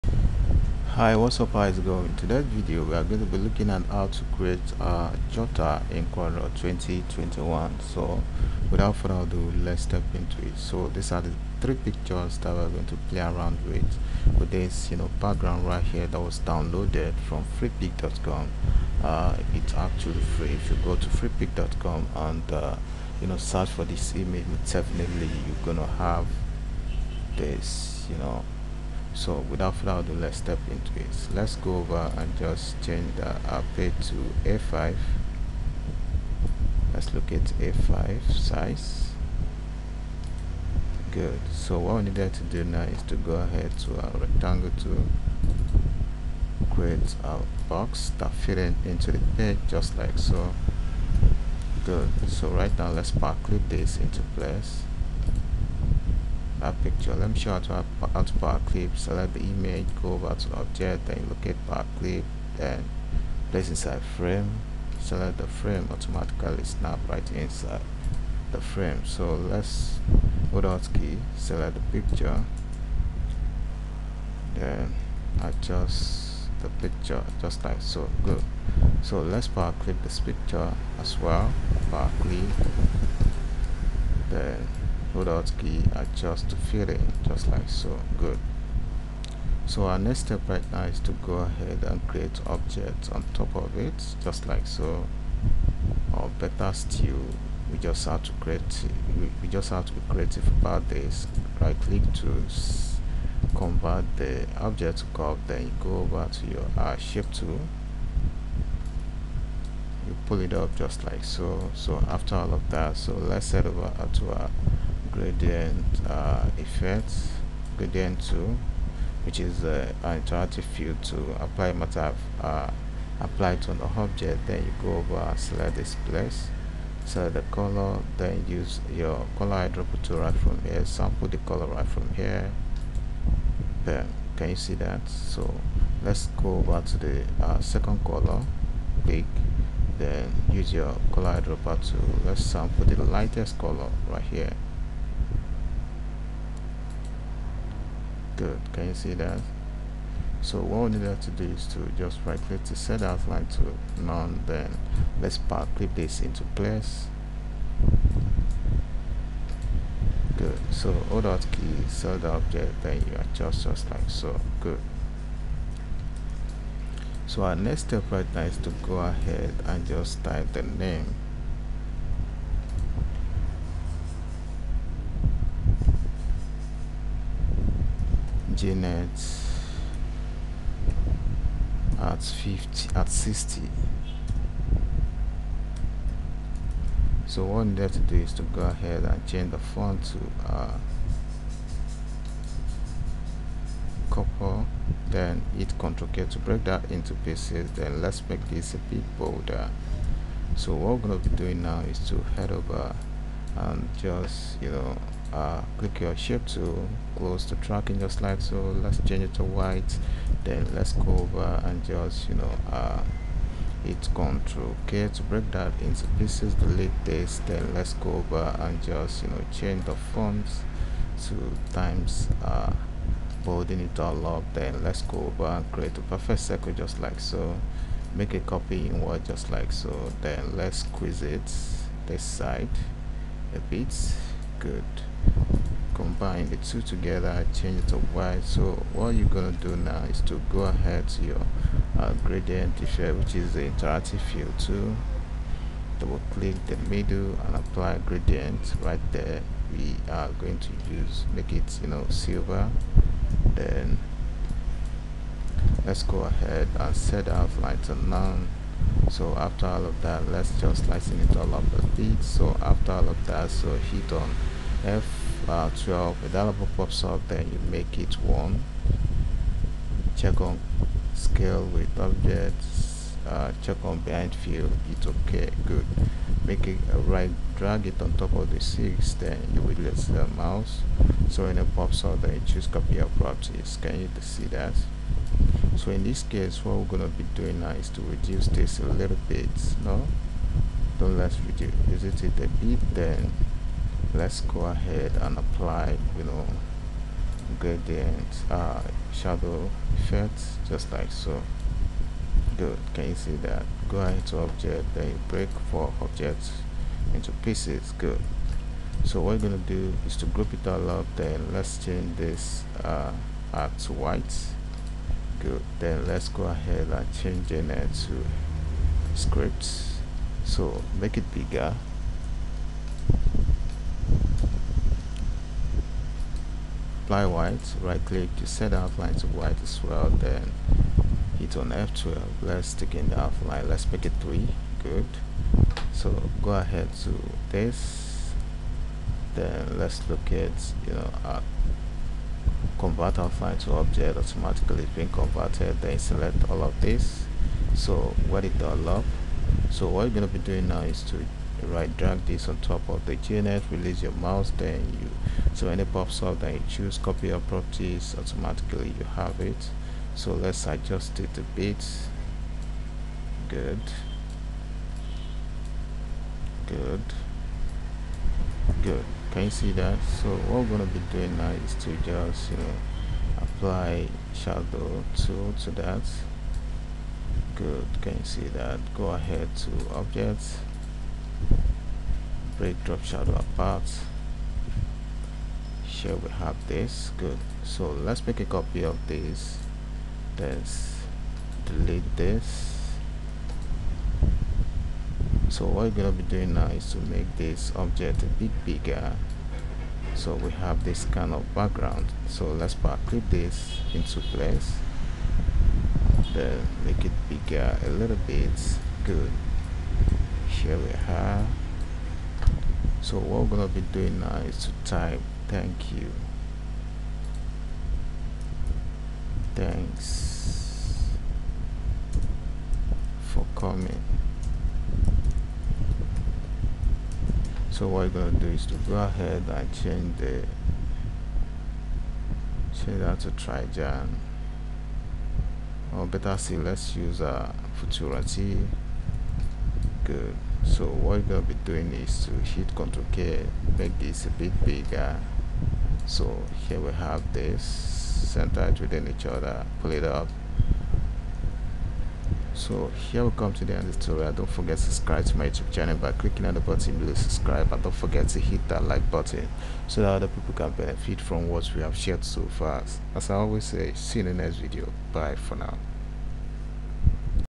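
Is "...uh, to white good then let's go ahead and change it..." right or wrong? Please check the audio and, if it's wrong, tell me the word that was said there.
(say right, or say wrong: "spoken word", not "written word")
right.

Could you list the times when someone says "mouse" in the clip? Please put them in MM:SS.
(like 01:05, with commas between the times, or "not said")
04:40, 05:54.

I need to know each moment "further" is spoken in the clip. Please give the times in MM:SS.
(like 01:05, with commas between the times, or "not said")
00:08, 00:29.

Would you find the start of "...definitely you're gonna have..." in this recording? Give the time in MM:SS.
00:24.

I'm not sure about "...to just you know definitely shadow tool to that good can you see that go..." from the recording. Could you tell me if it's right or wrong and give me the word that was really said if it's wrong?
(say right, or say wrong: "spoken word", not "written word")
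wrong: "apply", not "definitely".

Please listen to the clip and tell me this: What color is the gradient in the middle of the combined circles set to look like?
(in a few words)
Silver.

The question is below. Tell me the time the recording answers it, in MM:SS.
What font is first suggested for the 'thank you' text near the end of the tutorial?
07:13.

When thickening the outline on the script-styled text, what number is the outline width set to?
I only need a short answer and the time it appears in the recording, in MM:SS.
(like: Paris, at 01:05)
3, at 05:33.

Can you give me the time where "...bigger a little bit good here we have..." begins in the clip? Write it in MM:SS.
06:47.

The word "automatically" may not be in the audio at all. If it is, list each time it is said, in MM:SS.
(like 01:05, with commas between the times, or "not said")
01:05, 05:44, 05:58.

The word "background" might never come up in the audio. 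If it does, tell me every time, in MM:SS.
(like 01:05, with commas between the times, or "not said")
00:15, 06:41.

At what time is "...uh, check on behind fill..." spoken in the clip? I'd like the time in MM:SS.
04:33.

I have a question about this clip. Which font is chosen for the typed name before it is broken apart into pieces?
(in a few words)
Copper.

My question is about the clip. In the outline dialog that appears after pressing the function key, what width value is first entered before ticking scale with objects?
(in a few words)
1.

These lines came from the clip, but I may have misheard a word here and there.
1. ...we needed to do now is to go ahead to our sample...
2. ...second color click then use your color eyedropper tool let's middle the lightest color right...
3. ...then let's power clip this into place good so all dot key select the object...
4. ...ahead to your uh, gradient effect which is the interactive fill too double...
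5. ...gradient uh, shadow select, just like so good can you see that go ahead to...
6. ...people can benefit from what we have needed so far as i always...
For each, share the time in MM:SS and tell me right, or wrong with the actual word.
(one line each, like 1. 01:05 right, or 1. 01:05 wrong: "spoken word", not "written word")
1. 00:41 wrong: "rectangle", not "sample"
2. 02:17 wrong: "sample", not "middle"
3. 02:34 right
4. 04:00 right
5. 04:57 wrong: "effect", not "select"
6. 07:40 wrong: "shared", not "needed".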